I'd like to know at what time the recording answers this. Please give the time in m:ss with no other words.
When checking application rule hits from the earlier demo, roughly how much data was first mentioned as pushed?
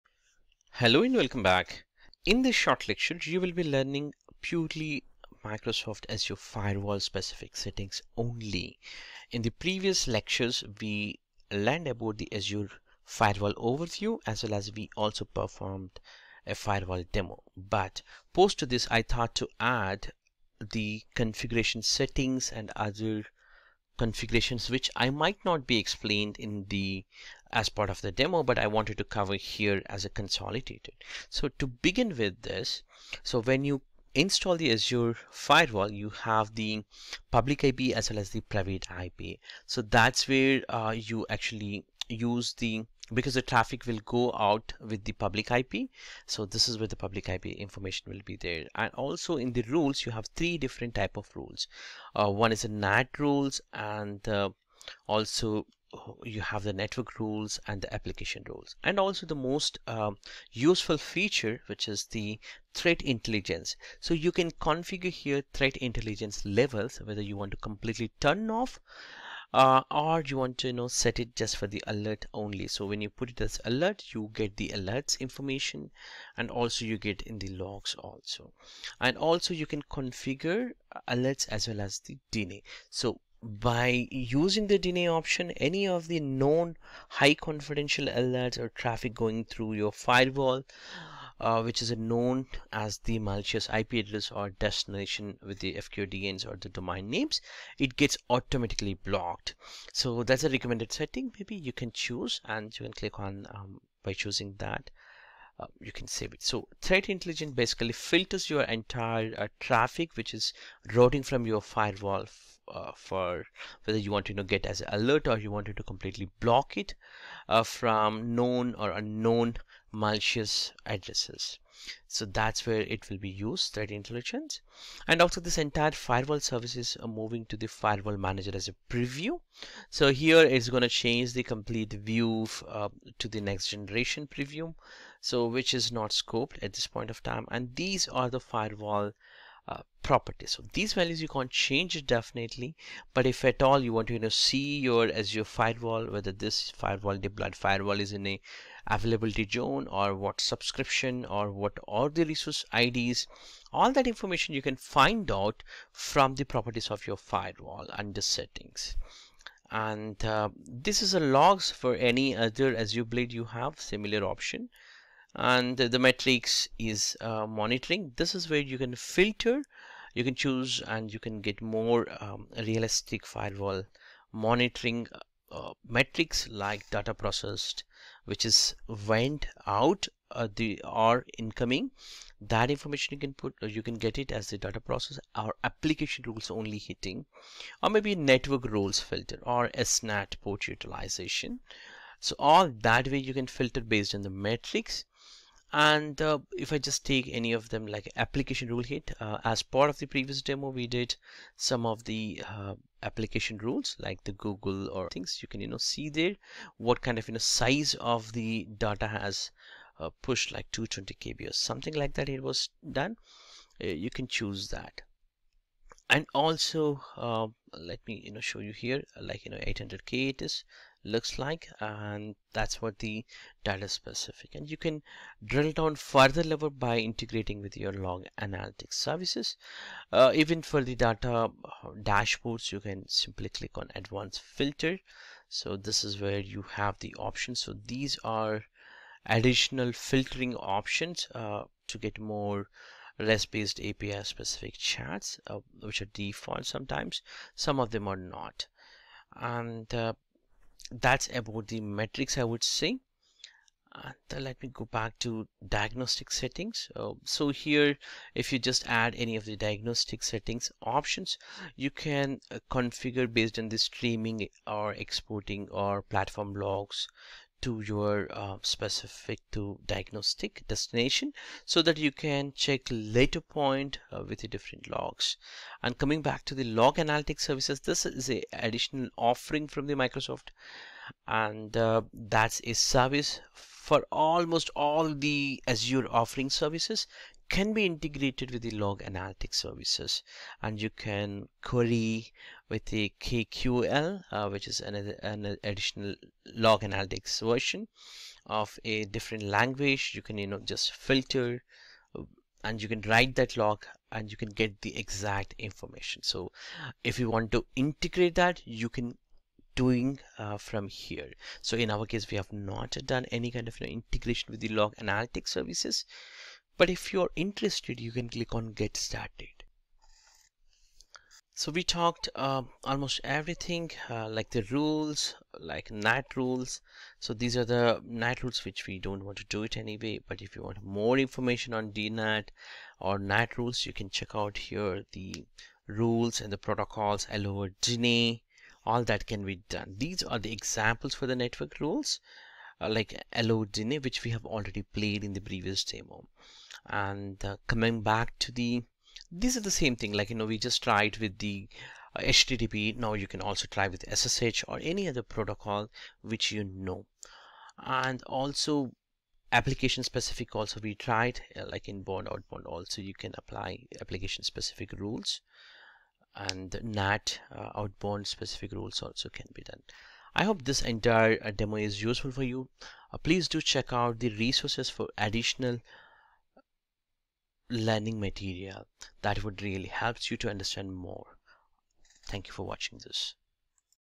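3:30.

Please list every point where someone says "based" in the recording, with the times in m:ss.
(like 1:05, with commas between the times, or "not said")
3:13, 4:03, 4:23.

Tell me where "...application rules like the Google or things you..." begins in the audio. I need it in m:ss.
3:23.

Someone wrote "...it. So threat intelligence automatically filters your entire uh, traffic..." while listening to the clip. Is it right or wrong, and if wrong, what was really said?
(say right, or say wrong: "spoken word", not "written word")
wrong: "basically", not "automatically".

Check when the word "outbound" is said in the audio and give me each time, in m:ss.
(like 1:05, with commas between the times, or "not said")
6:02, 6:07.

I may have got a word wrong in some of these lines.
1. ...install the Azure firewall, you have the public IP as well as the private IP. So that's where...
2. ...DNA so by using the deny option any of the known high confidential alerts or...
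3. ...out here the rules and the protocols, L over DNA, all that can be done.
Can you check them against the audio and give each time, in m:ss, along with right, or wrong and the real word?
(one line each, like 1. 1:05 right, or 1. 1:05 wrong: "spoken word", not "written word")
1. 0:34 right
2. 1:22 right
3. 5:34 right.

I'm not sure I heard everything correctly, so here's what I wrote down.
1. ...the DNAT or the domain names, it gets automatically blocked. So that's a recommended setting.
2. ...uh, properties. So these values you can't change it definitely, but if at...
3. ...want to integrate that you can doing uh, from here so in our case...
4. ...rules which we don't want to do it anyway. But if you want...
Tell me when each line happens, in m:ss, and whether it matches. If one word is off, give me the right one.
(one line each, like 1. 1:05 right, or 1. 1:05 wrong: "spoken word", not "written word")
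1. 1:35 wrong: "FQDNs", not "DNAT"
2. 2:19 right
3. 5:07 right
4. 5:28 right.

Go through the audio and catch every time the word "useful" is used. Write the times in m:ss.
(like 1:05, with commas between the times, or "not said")
1:00, 6:12.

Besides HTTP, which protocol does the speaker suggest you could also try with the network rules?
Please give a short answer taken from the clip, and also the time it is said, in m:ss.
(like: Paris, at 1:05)
SSH, at 5:54.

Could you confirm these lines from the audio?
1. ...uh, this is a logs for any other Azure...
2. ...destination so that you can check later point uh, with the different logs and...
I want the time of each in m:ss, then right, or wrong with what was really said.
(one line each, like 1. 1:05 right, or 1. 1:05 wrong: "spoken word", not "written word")
1. 2:40 right
2. 4:30 right.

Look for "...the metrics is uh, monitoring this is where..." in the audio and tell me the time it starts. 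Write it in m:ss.
2:45.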